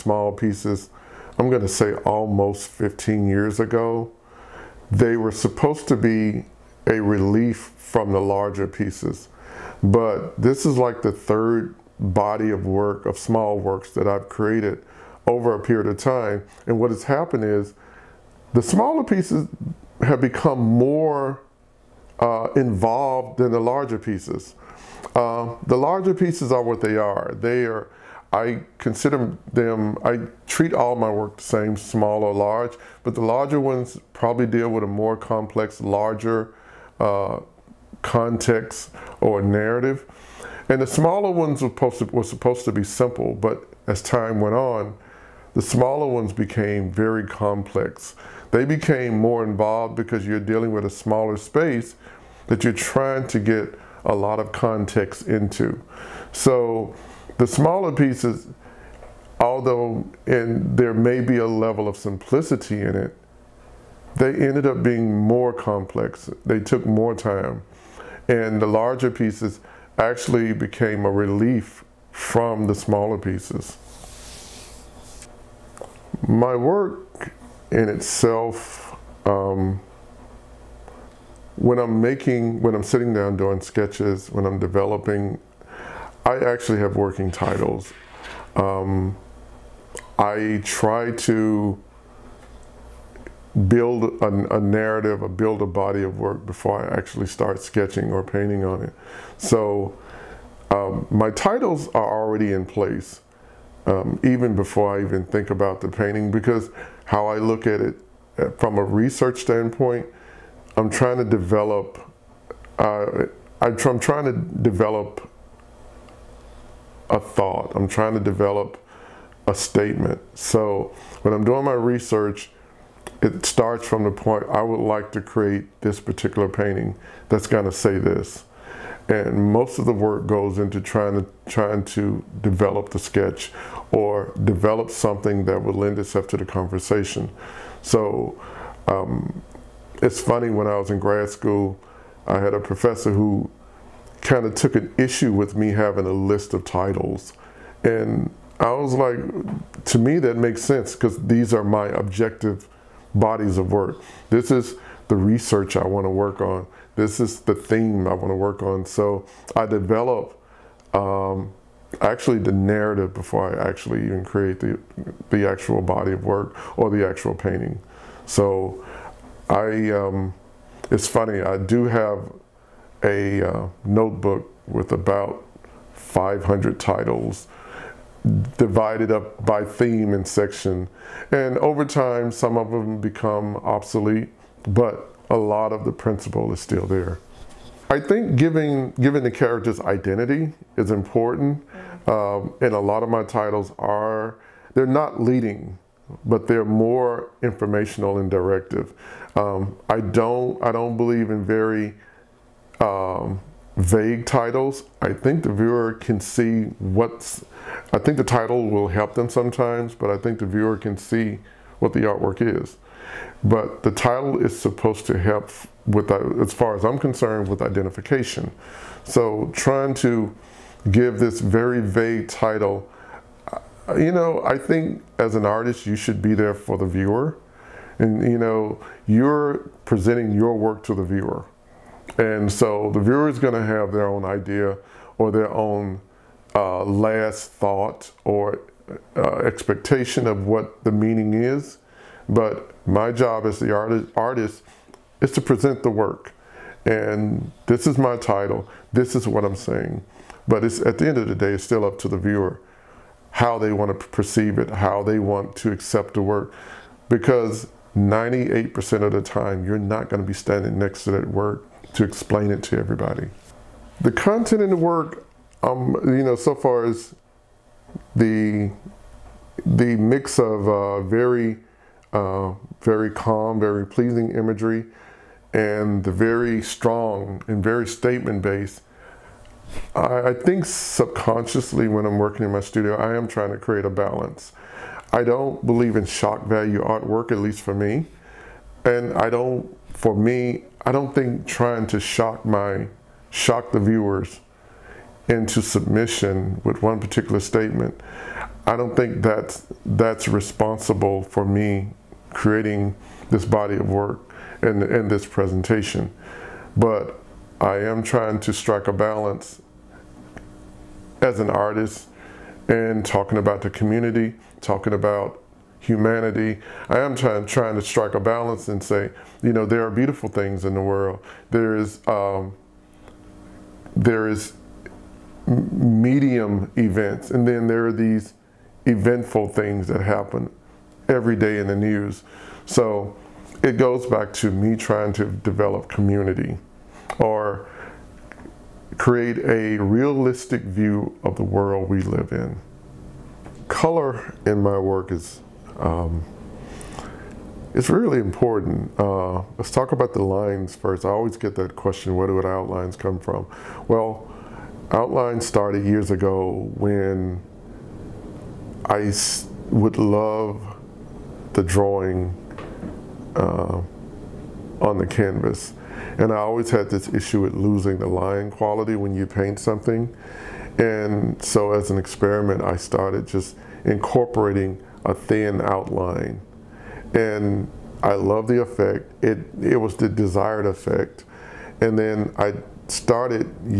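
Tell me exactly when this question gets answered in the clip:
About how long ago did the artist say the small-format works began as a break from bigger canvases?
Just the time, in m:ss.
0:02.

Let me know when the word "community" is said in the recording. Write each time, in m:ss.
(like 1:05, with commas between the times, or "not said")
5:13, 5:35.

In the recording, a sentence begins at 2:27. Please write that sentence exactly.
And I was like, to me, that makes sense because these are my objective bodies of work.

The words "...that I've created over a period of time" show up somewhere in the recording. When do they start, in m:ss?
0:13.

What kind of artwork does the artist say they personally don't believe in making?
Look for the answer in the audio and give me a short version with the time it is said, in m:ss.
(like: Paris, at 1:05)
shock value artwork, at 4:46.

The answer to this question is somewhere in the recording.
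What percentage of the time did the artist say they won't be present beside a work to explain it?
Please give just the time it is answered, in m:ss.
4:17.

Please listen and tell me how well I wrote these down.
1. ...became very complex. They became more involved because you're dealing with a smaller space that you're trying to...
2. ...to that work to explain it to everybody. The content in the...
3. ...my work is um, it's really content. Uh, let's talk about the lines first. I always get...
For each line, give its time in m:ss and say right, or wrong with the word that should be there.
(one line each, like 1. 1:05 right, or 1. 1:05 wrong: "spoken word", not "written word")
1. 0:46 right
2. 4:21 right
3. 5:44 wrong: "important", not "content".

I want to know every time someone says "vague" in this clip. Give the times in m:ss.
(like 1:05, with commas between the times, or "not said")
3:23, 3:41.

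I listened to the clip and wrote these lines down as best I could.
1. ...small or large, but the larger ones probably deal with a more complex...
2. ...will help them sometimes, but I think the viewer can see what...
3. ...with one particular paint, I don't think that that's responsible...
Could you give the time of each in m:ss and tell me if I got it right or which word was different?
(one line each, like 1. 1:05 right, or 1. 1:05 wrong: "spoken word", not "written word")
1. 0:31 right
2. 3:28 right
3. 4:56 wrong: "statement", not "paint".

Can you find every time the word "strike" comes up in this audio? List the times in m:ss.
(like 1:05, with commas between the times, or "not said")
5:08, 5:17.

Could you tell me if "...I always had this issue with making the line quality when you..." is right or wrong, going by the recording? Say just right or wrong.
wrong.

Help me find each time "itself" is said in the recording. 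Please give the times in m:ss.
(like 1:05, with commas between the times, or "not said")
1:17, 2:15.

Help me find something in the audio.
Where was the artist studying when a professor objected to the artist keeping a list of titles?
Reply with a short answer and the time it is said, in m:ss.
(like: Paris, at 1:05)
grad school, at 2:20.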